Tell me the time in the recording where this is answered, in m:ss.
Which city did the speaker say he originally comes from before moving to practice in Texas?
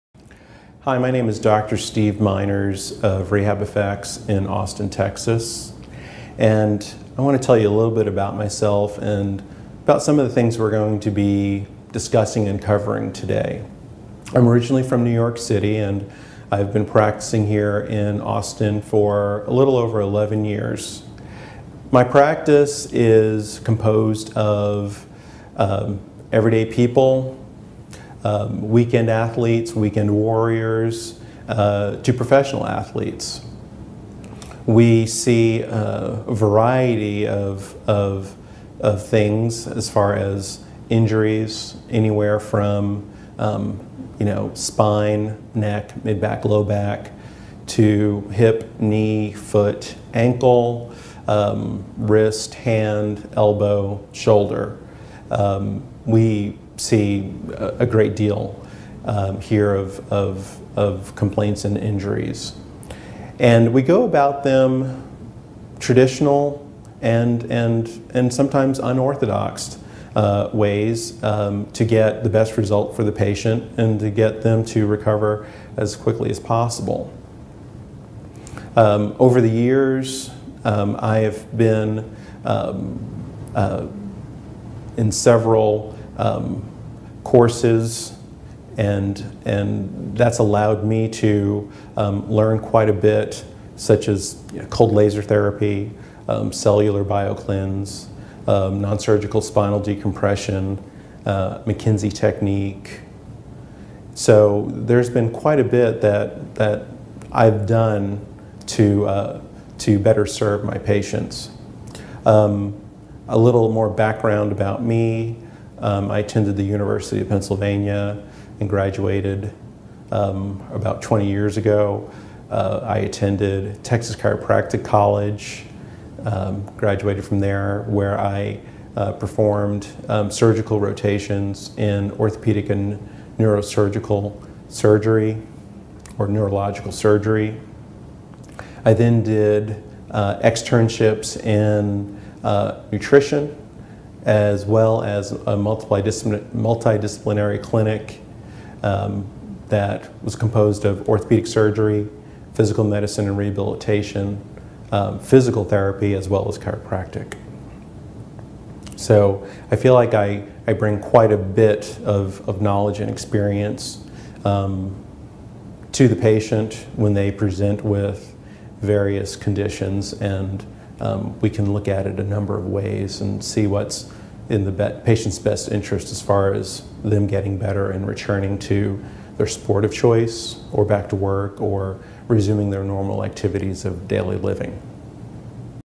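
0:15.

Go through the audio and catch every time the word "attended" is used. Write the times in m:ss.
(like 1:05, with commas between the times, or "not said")
1:56, 2:02.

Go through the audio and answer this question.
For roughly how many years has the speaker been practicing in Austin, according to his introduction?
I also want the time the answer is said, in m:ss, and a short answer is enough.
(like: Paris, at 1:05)
11, at 0:20.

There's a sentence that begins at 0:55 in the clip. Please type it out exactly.
Um, we see a, great deal um, here of, of, of complaints and injuries.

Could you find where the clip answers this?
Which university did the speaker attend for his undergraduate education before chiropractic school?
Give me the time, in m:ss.
1:56.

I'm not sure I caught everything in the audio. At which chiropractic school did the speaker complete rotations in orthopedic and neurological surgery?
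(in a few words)
Texas Chiropractic College.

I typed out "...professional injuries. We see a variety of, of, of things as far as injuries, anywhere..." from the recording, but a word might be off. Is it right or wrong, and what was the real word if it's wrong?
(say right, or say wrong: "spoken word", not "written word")
wrong: "athletes", not "injuries".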